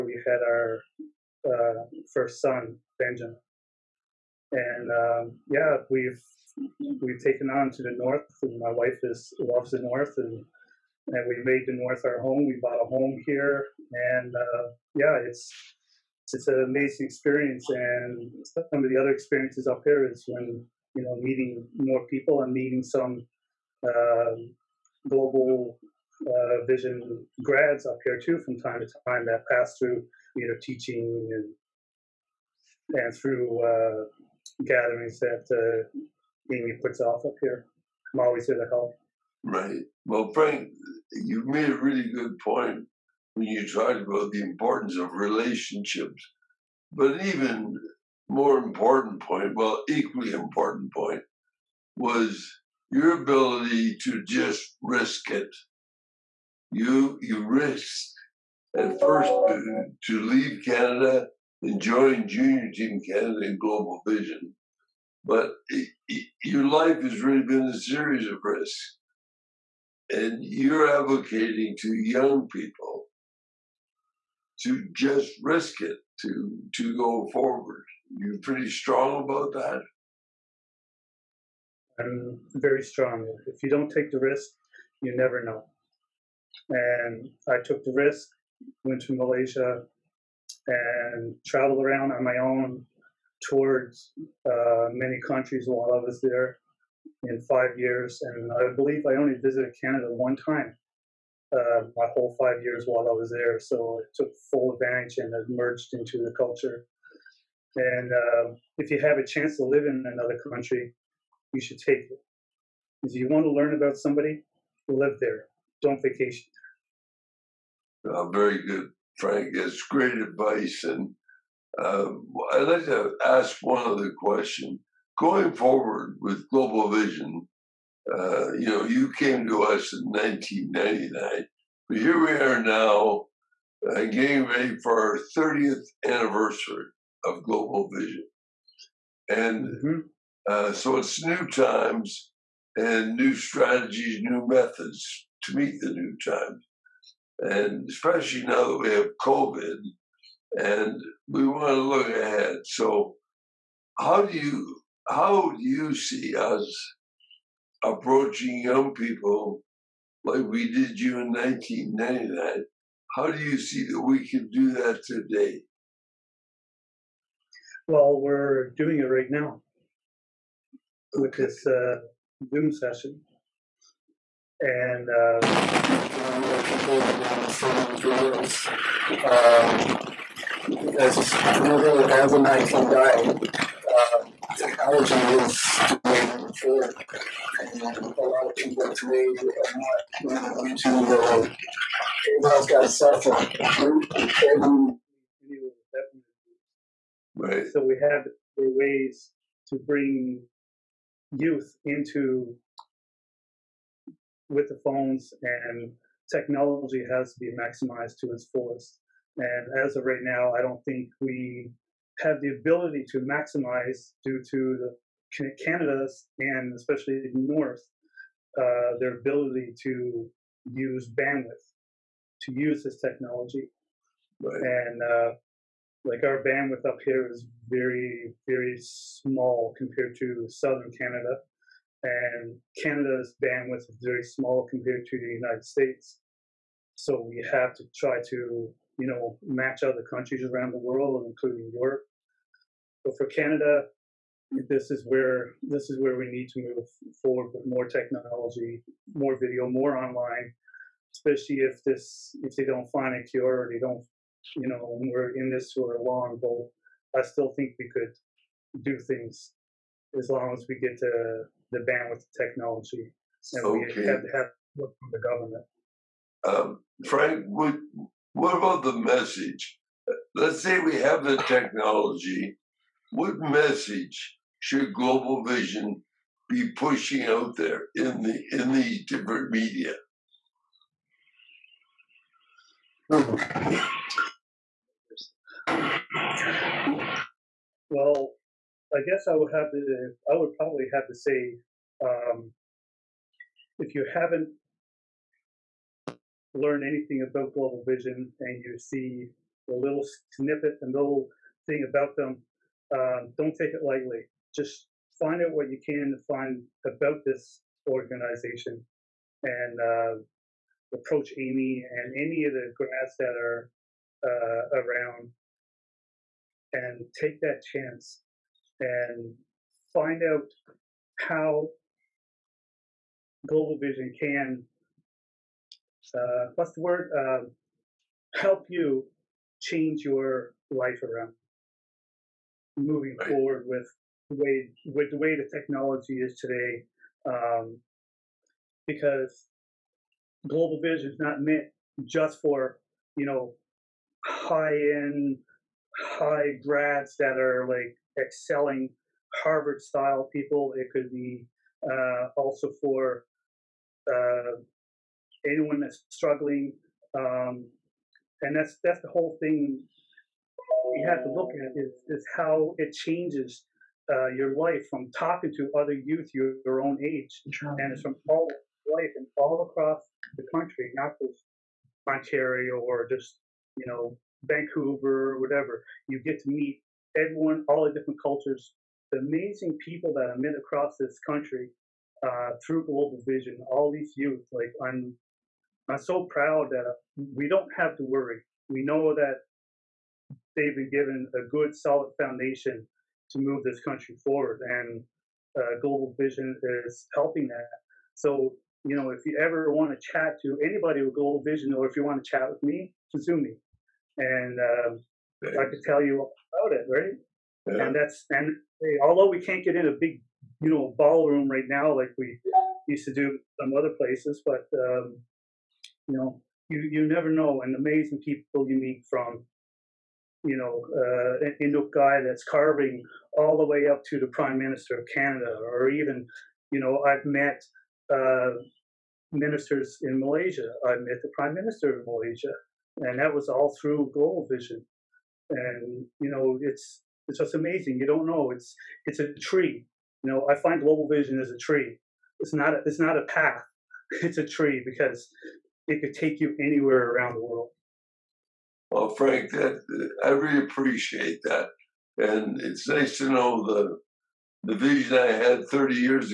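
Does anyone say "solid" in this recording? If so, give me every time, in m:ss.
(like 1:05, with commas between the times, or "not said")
6:31.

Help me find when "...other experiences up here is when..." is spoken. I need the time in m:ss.
0:18.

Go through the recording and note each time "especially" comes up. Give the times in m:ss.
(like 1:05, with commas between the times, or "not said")
2:27, 3:36, 4:11.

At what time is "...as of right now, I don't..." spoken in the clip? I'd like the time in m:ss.
3:29.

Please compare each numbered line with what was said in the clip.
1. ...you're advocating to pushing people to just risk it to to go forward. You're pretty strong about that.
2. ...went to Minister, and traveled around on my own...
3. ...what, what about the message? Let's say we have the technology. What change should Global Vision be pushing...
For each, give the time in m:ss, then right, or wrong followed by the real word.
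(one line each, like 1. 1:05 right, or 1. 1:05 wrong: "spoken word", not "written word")
1. 1:10 wrong: "young", not "pushing"
2. 1:28 wrong: "Malaysia", not "Minister"
3. 4:27 wrong: "message", not "change".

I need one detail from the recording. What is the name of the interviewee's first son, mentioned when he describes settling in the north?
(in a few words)
Benjamin.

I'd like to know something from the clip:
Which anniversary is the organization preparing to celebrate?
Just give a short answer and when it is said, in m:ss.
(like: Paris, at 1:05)
30th, at 2:15.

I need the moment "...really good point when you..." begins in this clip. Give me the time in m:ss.
0:41.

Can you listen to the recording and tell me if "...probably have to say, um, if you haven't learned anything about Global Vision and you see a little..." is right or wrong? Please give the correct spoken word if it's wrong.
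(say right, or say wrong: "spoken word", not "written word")
right.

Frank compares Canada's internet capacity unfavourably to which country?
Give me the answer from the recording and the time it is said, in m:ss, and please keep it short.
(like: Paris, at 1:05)
United States, at 3:55.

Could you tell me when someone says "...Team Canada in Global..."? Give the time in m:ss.
1:02.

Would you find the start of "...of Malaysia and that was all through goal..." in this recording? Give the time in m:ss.
7:12.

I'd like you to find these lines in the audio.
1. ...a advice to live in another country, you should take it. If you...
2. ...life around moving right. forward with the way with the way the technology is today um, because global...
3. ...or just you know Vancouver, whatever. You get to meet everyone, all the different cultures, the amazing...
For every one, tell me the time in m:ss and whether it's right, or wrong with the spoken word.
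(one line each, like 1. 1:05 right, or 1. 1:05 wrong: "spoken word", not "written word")
1. 1:49 wrong: "chance", not "advice"
2. 5:30 right
3. 6:12 right.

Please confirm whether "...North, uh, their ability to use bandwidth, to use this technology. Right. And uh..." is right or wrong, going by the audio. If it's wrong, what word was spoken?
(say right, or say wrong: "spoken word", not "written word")
right.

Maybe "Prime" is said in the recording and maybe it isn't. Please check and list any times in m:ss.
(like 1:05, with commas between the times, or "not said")
7:04, 7:11.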